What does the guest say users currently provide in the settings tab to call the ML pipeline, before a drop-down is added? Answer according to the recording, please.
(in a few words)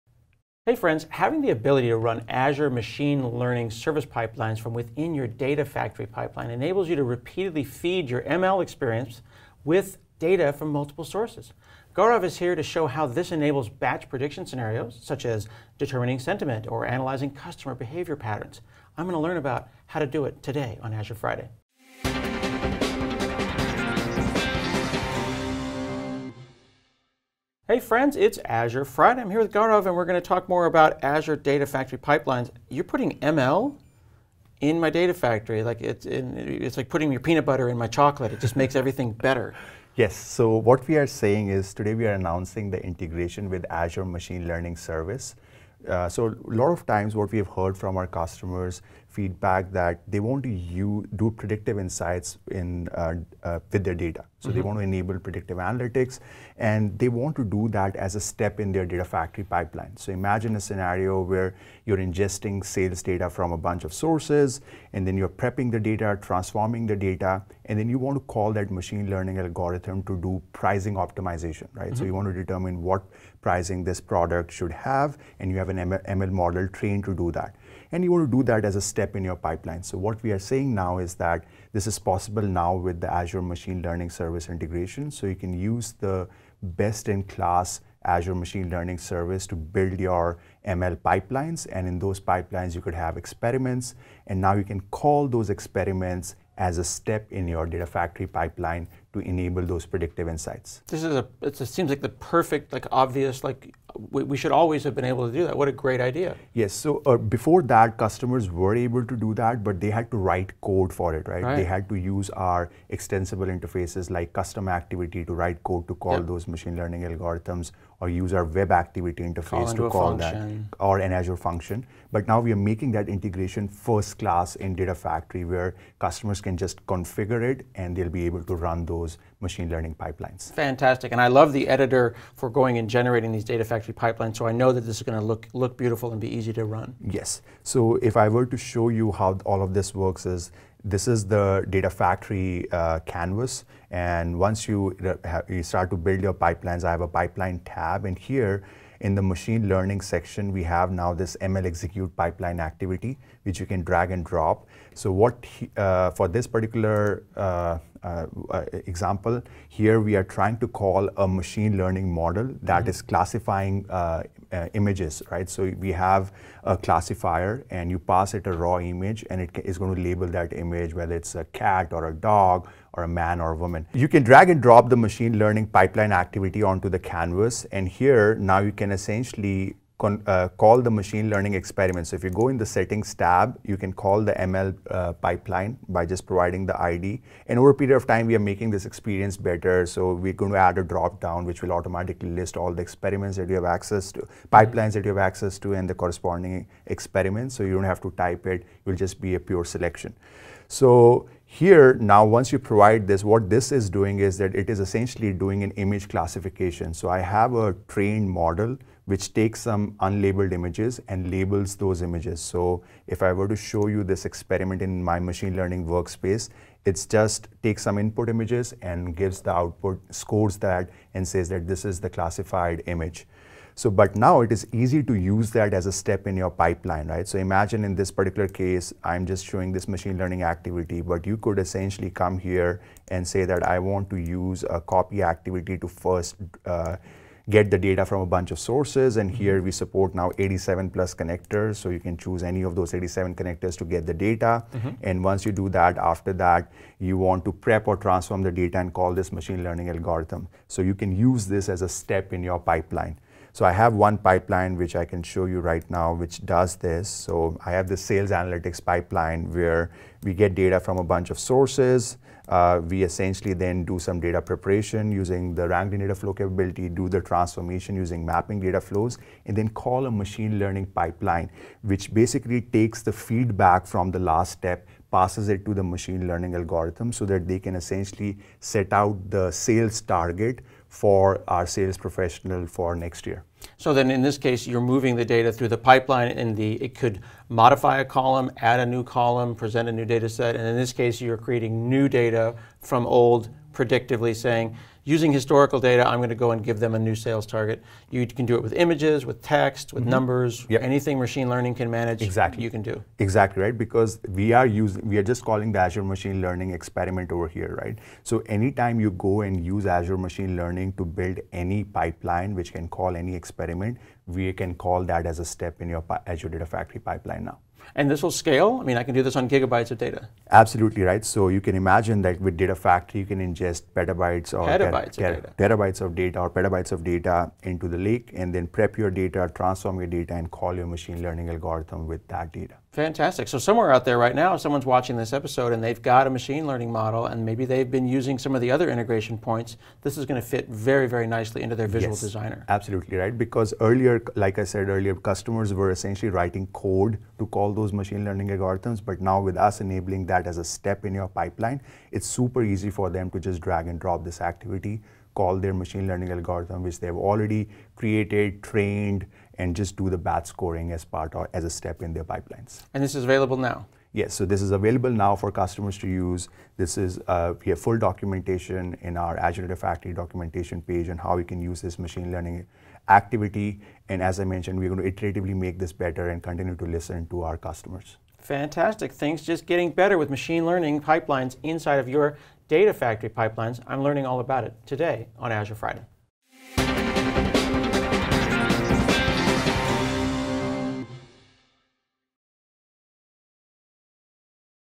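The ID.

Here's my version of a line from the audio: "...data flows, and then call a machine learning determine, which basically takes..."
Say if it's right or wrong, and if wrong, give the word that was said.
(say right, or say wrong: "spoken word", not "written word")
wrong: "pipeline", not "determine".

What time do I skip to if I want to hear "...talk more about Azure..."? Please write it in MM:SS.
00:30.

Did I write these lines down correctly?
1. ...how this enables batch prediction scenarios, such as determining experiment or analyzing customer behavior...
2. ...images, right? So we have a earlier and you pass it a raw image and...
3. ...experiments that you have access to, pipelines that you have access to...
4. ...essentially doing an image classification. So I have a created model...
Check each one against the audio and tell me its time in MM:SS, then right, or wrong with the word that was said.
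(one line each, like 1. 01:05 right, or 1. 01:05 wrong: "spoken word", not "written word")
1. 00:12 wrong: "sentiment", not "experiment"
2. 02:44 wrong: "classifier", not "earlier"
3. 03:12 right
4. 03:24 wrong: "trained", not "created".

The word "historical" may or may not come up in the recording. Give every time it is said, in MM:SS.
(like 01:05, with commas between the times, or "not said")
04:55.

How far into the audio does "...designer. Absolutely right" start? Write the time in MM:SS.
05:42.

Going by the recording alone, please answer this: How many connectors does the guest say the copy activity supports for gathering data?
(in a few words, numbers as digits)
87+.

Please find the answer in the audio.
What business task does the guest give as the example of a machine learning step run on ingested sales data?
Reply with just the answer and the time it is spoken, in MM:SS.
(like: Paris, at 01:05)
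Pricing optimization, at 01:10.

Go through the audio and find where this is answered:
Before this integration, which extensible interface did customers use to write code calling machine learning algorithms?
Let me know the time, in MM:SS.
01:54.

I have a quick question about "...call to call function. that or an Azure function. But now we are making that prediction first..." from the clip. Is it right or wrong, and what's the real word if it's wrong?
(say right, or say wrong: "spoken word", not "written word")
wrong: "integration", not "prediction".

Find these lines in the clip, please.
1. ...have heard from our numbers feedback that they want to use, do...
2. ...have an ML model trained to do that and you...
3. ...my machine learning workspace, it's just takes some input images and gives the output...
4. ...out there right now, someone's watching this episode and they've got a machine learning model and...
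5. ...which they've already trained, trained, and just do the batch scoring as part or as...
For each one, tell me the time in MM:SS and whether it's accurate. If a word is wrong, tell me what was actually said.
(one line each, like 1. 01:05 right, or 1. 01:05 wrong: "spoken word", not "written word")
1. 00:47 wrong: "customers", not "numbers"
2. 01:15 right
3. 03:35 right
4. 05:33 right
5. 05:56 wrong: "created", not "trained".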